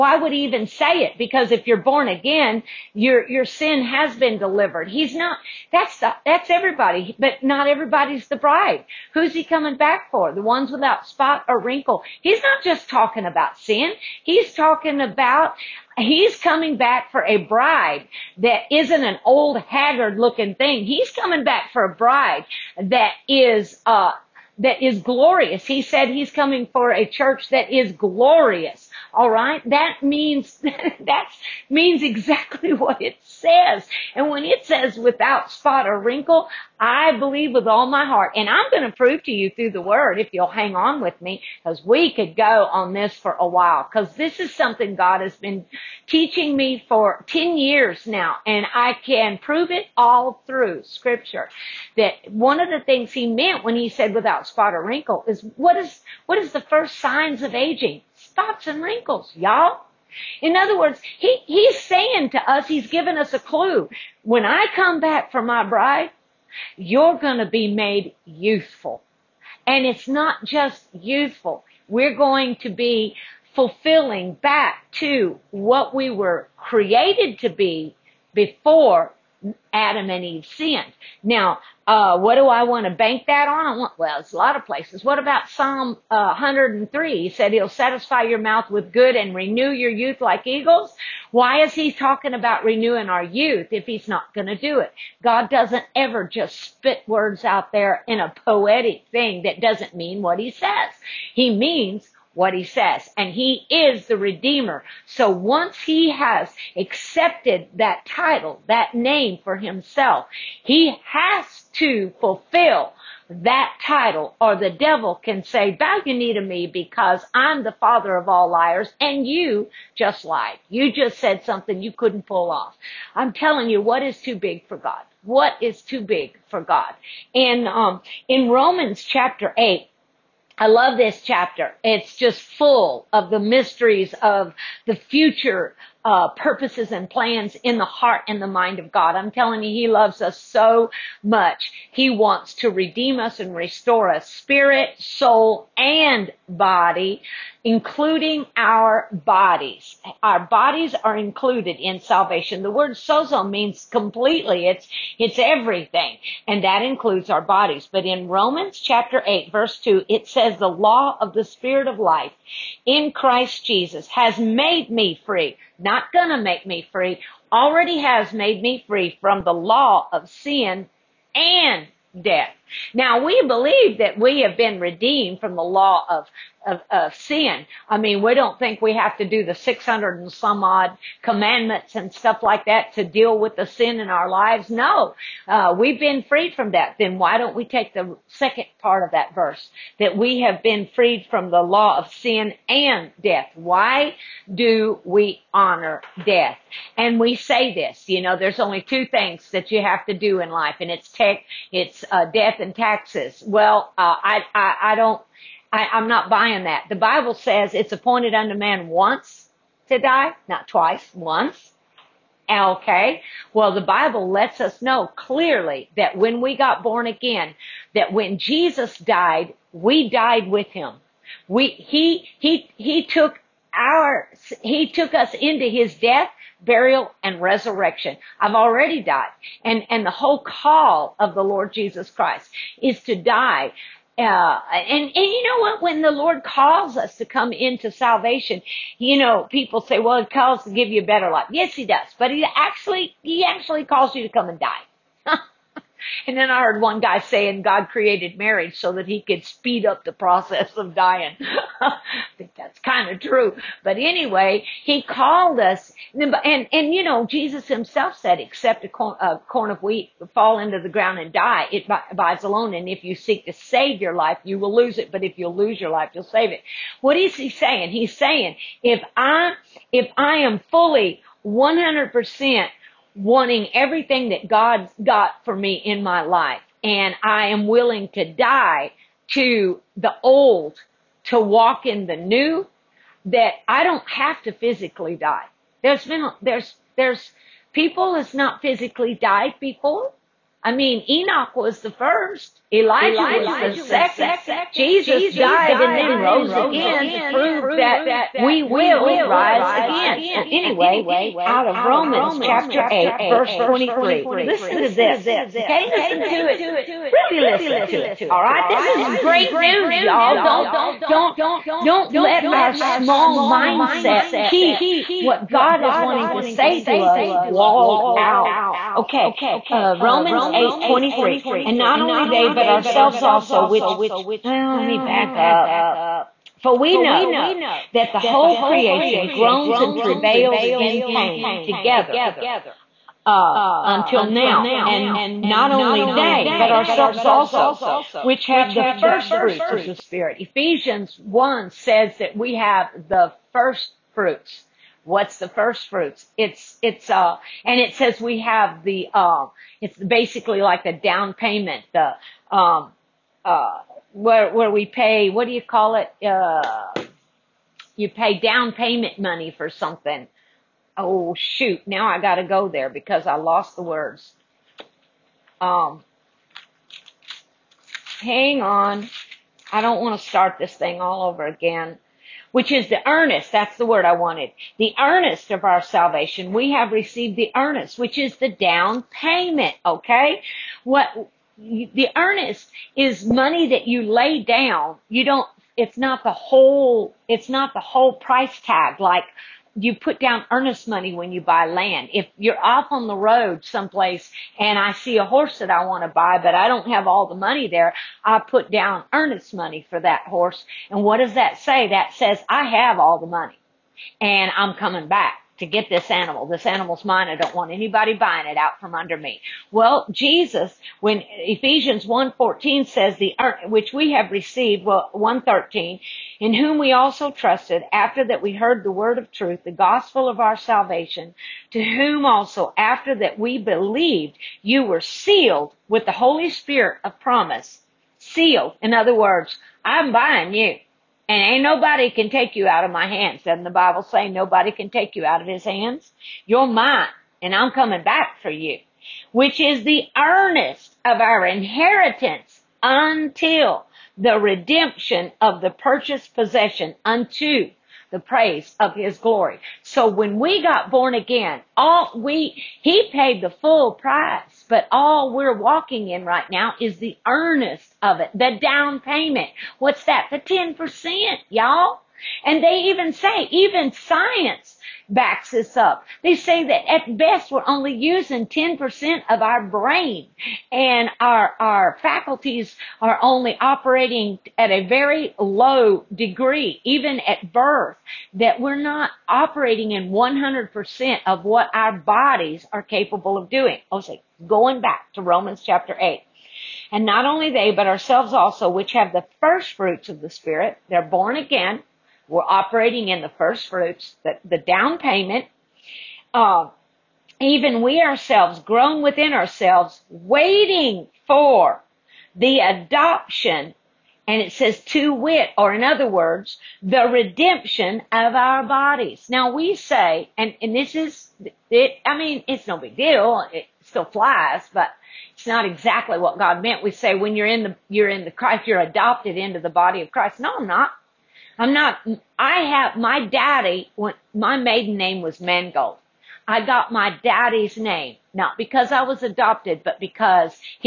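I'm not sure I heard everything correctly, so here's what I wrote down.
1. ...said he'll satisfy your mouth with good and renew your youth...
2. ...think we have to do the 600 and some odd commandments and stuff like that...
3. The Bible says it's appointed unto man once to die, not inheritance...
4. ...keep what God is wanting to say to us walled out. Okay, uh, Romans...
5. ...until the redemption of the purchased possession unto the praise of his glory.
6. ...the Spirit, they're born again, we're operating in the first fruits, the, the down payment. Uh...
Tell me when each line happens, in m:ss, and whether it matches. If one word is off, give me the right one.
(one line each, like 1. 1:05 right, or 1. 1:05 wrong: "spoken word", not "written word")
1. 1:27 right
2. 2:58 right
3. 3:26 wrong: "twice", not "inheritance"
4. 5:14 right
5. 7:22 right
6. 8:10 right.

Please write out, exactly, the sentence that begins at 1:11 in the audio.
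We're going to be fulfilling back to what we were created to be before Adam and Eve sinned.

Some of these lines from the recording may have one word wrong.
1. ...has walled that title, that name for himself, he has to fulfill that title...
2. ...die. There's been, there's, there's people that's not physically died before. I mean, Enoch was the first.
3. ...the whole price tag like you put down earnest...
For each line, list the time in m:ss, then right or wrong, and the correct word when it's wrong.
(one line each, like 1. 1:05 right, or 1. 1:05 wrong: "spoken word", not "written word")
1. 1:46 wrong: "accepted", not "walled"
2. 4:45 right
3. 6:27 right.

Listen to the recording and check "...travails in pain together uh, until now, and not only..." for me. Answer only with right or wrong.
right.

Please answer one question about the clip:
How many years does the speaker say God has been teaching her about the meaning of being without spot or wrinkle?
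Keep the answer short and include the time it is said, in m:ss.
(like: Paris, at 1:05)
10 years, at 0:47.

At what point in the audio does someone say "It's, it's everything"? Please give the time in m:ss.
2:34.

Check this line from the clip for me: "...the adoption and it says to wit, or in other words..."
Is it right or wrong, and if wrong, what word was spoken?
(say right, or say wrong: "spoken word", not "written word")
right.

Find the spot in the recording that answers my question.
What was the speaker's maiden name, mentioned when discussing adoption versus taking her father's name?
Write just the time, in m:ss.
8:45.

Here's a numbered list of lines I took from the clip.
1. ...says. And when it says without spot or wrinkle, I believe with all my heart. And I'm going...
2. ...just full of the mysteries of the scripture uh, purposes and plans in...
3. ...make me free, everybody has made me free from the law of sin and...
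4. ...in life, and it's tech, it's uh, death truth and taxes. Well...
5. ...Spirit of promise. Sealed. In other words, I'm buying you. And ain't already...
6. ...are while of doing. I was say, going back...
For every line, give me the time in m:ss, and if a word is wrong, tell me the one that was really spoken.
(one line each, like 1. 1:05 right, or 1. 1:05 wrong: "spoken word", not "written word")
1. 0:33 right
2. 2:12 wrong: "future", not "scripture"
3. 2:46 wrong: "already", not "everybody"
4. 3:20 wrong: "death", not "truth"
5. 7:06 wrong: "nobody", not "already"
6. 8:02 wrong: "capable", not "while".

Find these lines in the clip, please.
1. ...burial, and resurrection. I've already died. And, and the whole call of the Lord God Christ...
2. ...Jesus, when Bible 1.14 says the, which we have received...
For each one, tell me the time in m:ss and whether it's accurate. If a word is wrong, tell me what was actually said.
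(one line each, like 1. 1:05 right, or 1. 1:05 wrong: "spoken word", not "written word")
1. 3:46 wrong: "Jesus", not "God"
2. 6:50 wrong: "Ephesians", not "Bible".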